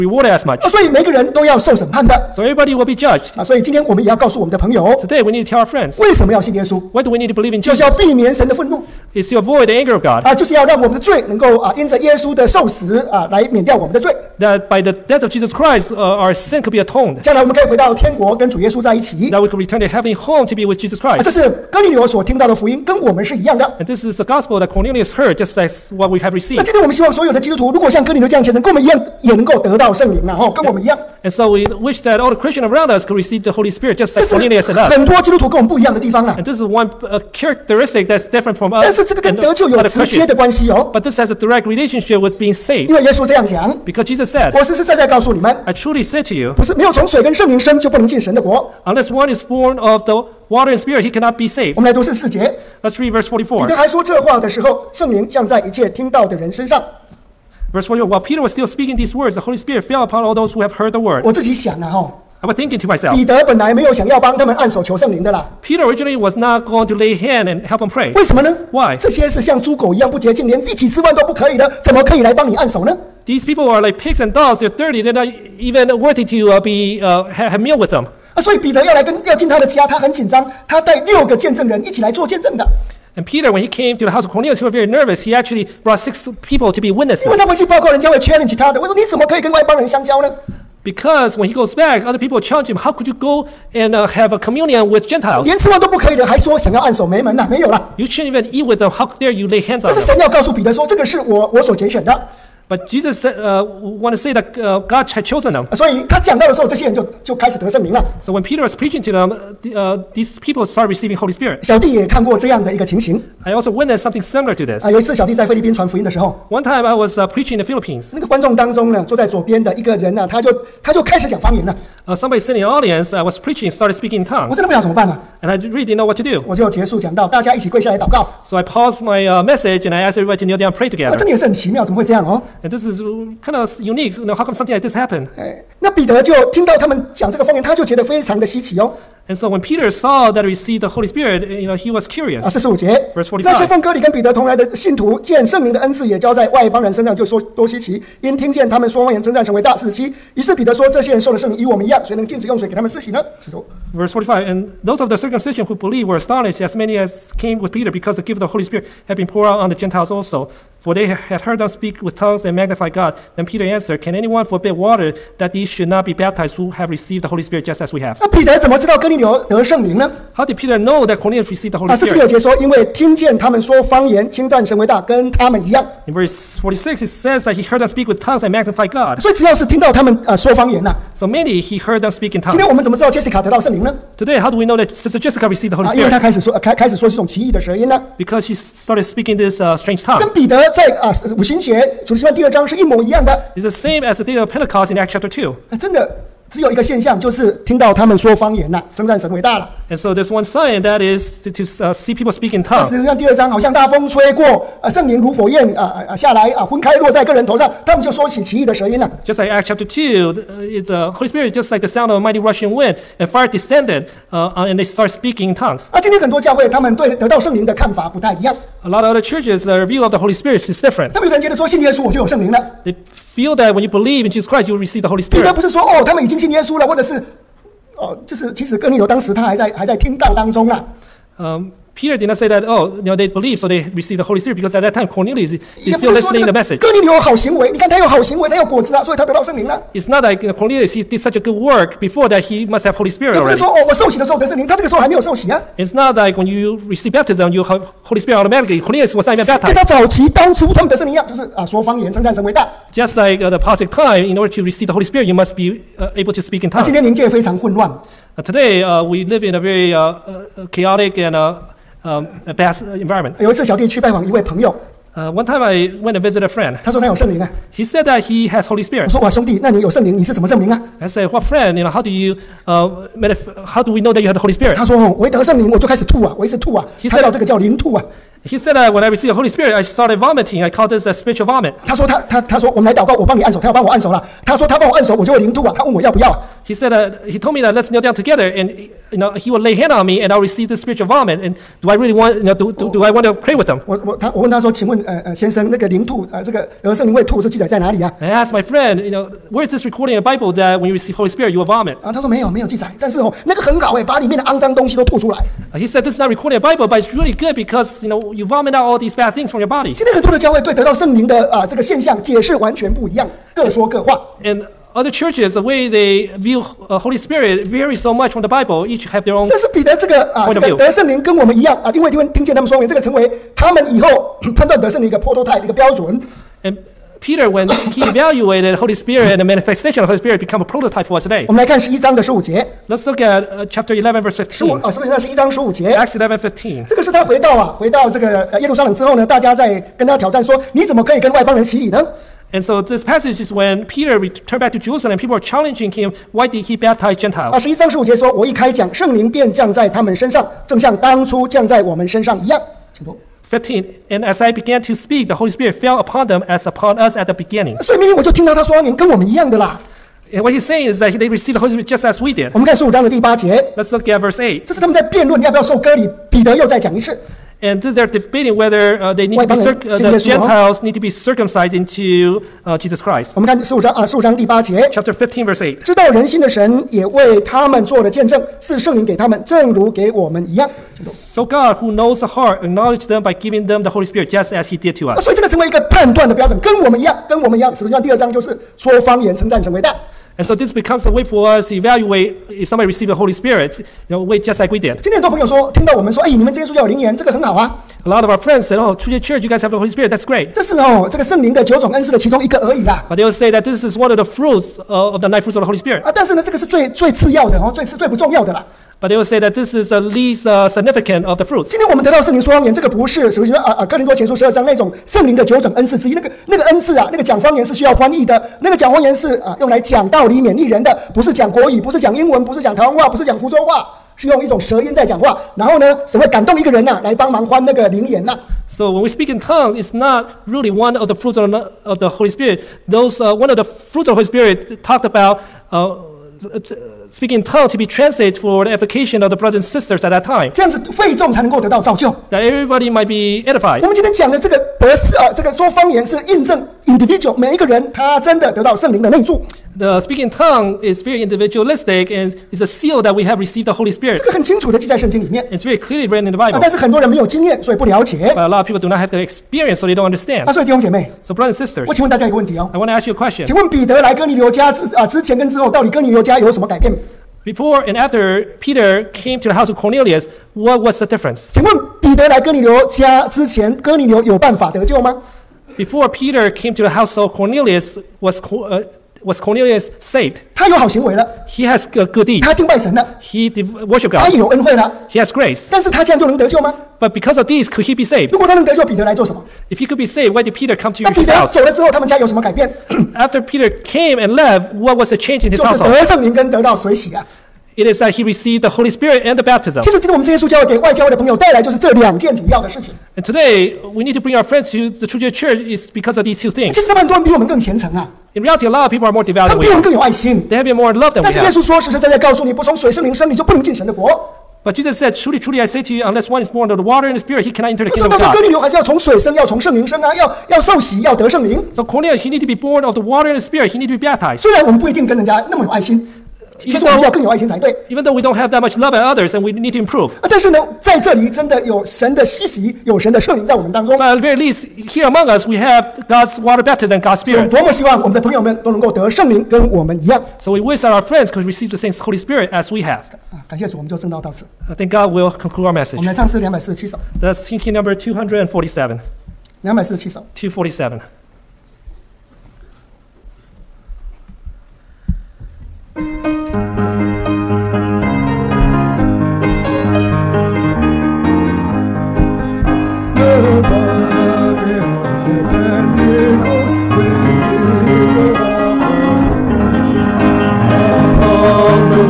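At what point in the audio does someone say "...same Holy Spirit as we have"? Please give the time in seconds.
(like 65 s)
541 s.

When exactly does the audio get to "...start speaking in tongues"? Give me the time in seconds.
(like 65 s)
214 s.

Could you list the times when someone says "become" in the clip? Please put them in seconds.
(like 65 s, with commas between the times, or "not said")
330 s, 390 s.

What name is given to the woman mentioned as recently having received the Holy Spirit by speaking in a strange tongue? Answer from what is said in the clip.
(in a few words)
Jessica.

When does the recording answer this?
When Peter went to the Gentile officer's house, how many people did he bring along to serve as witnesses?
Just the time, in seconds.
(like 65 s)
85 s.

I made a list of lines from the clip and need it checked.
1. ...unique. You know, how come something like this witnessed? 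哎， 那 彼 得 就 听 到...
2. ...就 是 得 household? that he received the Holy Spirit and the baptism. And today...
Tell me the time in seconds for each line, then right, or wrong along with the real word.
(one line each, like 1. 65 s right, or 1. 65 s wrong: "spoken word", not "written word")
1. 133 s wrong: "happened", not "witnessed"
2. 495 s right.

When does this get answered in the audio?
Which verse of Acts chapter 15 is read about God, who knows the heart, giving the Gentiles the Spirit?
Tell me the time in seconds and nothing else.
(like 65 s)
374 s.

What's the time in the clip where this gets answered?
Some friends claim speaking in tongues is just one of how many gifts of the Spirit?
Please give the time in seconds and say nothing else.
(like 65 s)
405 s.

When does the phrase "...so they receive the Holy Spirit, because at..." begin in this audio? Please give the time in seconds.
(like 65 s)
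233 s.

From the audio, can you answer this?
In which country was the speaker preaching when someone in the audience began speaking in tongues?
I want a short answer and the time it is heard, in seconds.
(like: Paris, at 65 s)
Philippines, at 117 s.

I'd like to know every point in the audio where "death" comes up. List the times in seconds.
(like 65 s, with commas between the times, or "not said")
15 s.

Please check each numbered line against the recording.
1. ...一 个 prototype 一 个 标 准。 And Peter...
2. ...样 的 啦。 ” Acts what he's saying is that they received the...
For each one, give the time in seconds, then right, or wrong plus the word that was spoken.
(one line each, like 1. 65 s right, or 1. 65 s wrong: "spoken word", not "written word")
1. 325 s right
2. 359 s wrong: "And", not "Acts".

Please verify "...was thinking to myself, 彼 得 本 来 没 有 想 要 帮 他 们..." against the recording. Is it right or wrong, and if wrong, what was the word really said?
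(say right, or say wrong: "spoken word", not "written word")
right.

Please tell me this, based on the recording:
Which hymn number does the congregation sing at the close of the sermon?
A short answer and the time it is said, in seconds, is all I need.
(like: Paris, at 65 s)
247, at 547 s.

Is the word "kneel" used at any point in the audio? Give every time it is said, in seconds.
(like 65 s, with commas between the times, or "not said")
130 s, 287 s.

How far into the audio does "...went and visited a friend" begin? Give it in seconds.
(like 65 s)
266 s.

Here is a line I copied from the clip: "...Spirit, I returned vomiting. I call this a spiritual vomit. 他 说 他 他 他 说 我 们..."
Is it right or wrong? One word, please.
wrong.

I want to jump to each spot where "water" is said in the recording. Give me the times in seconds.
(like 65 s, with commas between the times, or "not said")
50 s, 164 s, 516 s, 523 s, 536 s.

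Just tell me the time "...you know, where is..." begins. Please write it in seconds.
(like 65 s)
299 s.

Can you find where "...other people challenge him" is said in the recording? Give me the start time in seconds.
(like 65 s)
92 s.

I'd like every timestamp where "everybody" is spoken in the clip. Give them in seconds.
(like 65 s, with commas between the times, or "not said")
2 s, 130 s, 442 s.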